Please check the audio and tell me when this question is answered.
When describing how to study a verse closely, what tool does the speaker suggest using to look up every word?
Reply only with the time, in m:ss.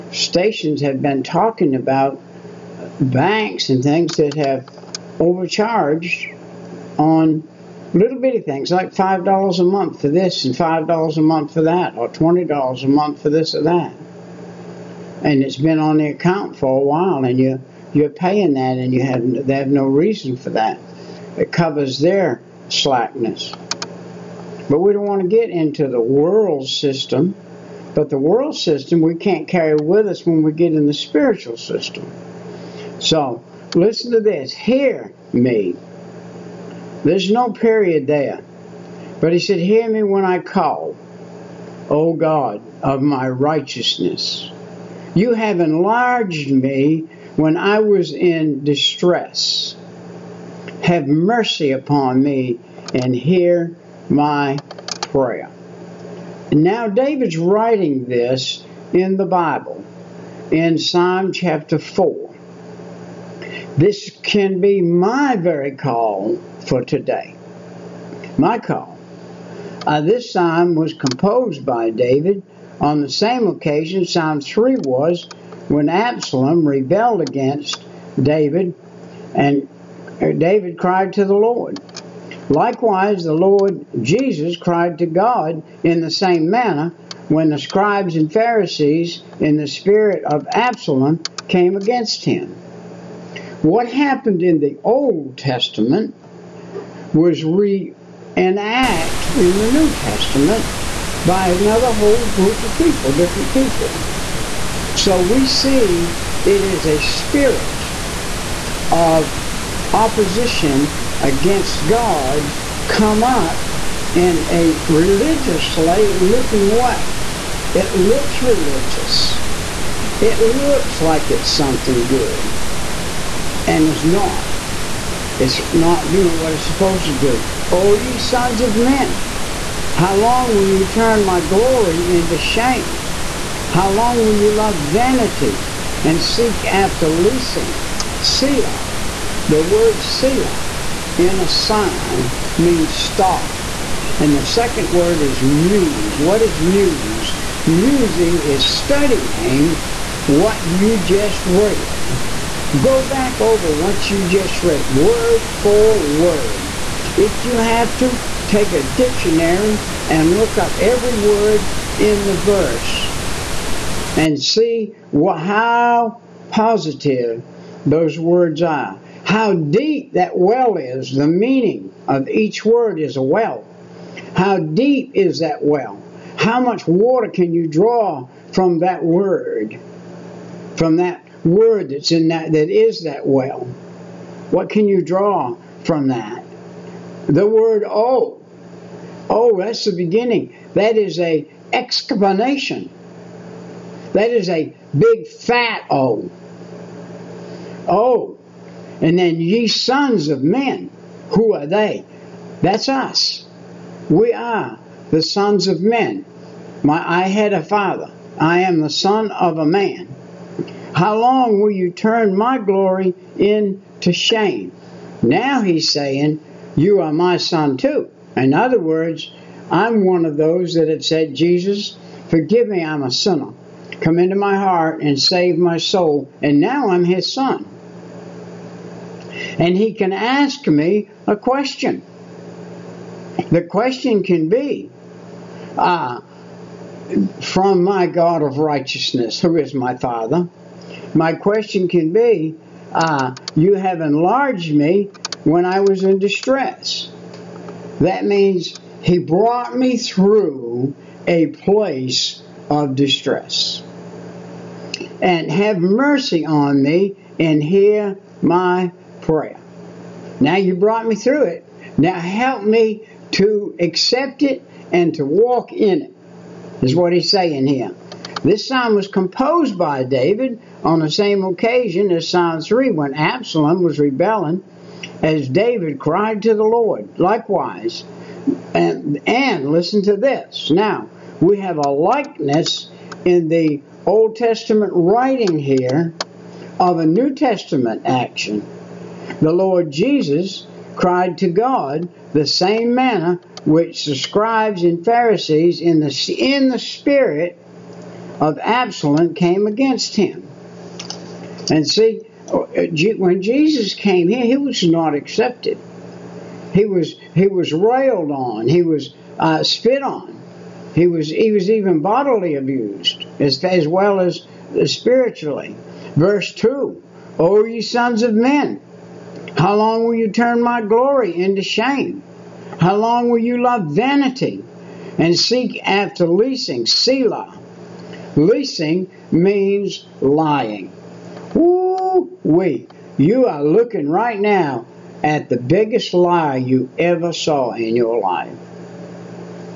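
2:38.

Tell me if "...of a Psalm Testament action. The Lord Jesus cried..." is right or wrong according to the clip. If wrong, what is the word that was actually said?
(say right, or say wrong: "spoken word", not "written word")
wrong: "New", not "Psalm".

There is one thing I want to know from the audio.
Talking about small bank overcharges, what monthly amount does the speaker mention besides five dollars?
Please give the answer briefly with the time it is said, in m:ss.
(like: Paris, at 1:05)
$20, at 0:12.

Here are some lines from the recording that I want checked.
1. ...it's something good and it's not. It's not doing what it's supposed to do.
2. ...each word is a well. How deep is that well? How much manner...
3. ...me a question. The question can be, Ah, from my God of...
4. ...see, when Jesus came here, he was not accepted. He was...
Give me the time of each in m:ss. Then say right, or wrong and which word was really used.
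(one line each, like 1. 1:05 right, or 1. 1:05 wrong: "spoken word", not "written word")
1. 2:01 right
2. 2:52 wrong: "water", not "manner"
3. 3:50 right
4. 5:01 right.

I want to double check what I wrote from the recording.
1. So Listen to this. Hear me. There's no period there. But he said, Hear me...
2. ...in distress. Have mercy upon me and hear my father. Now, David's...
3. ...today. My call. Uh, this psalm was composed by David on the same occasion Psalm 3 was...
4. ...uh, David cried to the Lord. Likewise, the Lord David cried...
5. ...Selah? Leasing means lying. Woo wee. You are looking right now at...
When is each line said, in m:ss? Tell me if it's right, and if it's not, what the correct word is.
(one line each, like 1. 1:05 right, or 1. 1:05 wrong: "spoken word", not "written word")
1. 0:32 right
2. 0:48 wrong: "prayer", not "father"
3. 1:06 right
4. 1:20 wrong: "Jesus", not "David"
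5. 5:26 right.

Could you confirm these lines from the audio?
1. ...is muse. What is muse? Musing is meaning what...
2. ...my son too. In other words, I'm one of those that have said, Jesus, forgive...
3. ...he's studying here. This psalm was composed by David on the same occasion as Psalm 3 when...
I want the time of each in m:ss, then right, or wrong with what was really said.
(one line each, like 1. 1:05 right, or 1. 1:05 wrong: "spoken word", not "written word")
1. 2:25 wrong: "studying", not "meaning"
2. 3:37 right
3. 4:27 wrong: "saying", not "studying".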